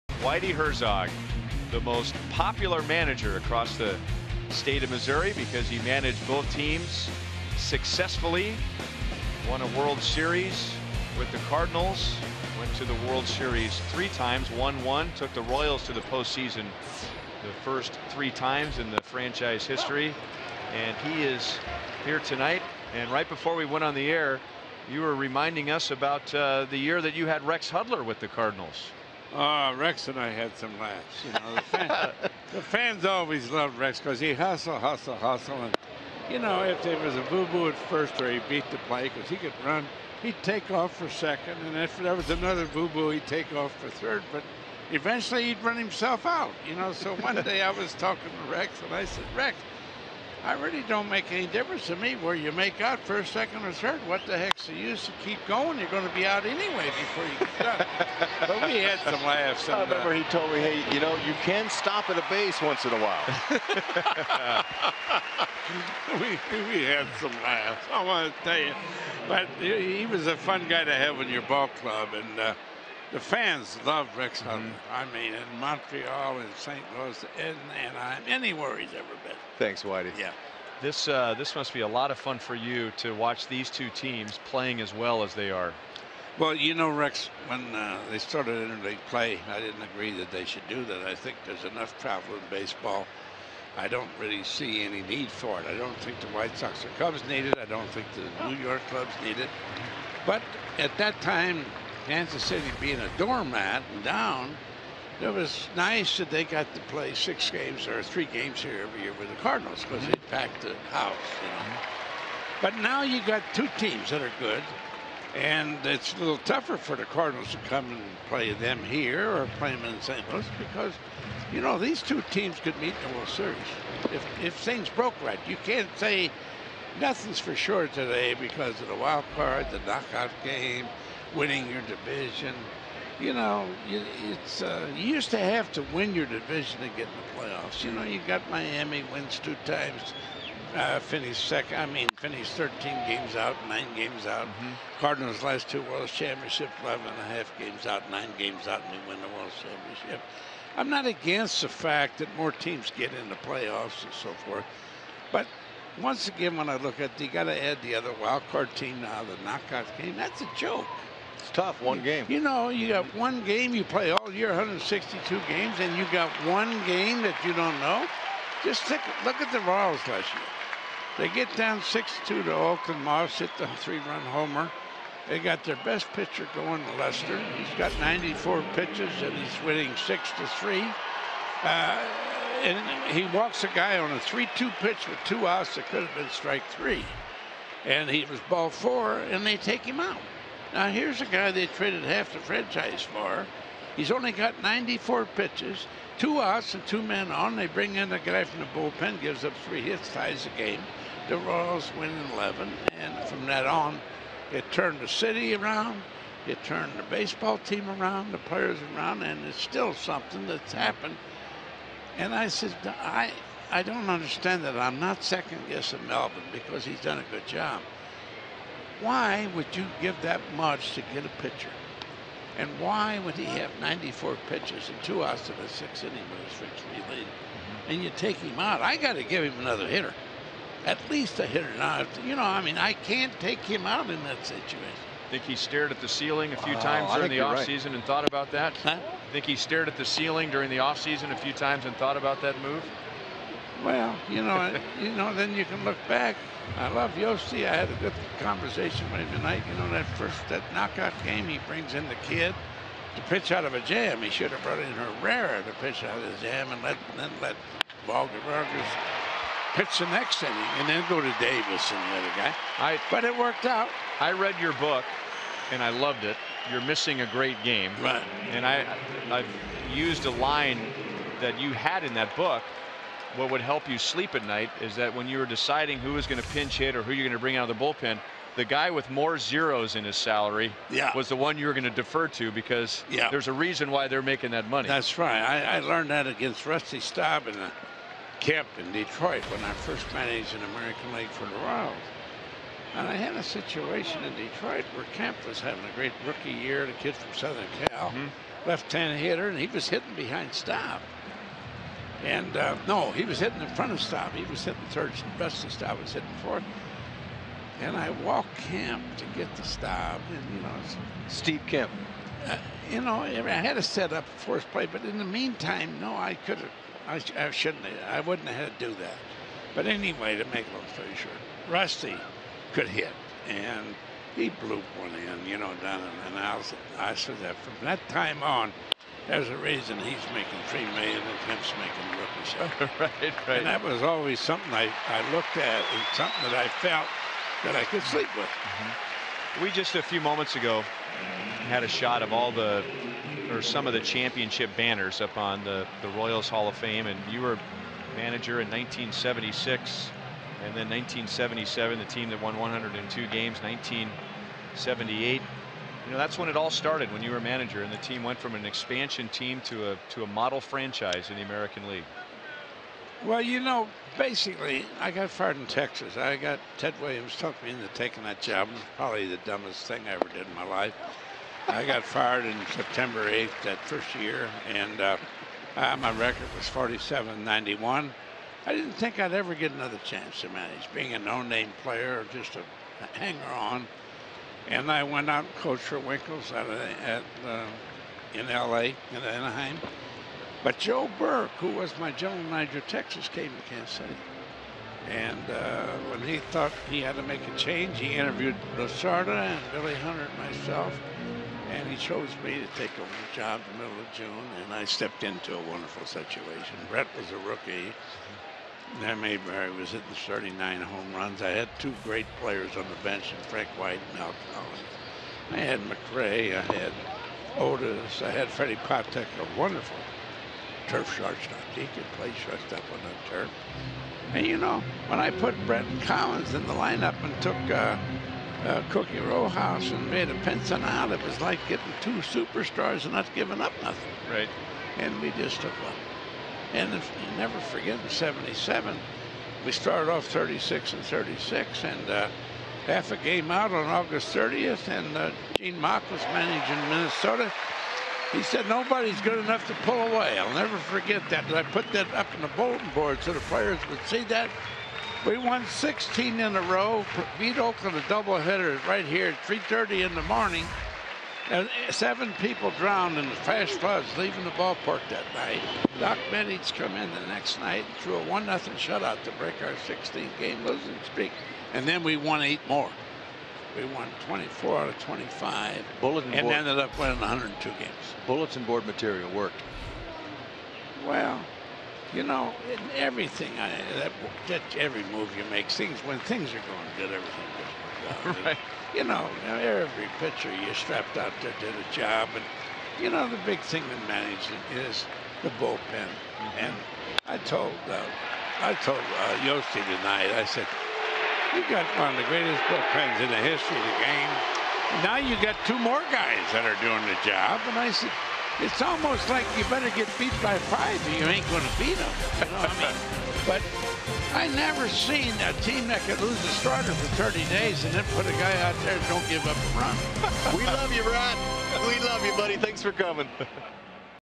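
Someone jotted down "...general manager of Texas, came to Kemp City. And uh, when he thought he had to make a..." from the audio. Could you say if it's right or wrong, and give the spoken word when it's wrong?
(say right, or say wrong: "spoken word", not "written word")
wrong: "Kansas", not "Kemp".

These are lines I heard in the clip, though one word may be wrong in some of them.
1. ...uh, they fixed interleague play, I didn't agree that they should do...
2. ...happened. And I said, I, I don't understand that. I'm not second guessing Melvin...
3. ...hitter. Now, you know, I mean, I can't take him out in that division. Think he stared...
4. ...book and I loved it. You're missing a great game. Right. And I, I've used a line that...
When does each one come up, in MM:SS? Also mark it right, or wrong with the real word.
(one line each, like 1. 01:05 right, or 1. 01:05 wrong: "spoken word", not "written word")
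1. 01:27 wrong: "started", not "fixed"
2. 03:30 right
3. 03:51 wrong: "situation", not "division"
4. 04:24 right.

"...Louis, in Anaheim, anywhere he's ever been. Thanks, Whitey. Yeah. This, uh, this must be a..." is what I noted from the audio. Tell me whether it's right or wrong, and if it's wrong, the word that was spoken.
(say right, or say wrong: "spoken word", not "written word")
right.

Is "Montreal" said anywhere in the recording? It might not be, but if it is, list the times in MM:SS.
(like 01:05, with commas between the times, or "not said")
01:15.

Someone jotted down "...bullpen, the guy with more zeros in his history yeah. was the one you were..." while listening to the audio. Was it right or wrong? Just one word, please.
wrong.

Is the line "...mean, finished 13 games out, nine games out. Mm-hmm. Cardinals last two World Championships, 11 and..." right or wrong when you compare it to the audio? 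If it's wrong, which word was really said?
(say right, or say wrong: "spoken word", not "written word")
right.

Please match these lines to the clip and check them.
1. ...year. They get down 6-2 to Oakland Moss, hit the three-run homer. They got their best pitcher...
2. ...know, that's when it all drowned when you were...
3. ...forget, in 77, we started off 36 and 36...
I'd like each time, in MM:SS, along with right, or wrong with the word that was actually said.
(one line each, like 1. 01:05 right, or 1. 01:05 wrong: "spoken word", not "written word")
1. 02:50 right
2. 05:56 wrong: "started", not "drowned"
3. 07:17 right.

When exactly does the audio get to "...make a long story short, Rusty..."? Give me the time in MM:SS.
05:20.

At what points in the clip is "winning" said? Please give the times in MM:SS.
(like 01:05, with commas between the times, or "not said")
02:11, 02:59, 07:56.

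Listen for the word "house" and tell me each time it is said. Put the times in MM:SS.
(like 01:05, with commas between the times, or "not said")
01:50, 05:26.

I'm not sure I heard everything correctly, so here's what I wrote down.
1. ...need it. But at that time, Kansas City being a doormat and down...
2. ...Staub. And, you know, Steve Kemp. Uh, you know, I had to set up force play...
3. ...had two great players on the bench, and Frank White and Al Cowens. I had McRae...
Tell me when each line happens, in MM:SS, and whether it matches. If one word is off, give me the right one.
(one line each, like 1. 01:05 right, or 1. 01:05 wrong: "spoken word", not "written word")
1. 01:39 right
2. 05:09 right
3. 06:51 right.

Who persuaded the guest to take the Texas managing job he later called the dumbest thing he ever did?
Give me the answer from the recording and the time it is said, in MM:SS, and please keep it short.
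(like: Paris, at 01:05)
Ted Williams, at 06:06.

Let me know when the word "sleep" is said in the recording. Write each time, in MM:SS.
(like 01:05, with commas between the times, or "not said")
04:33, 05:38.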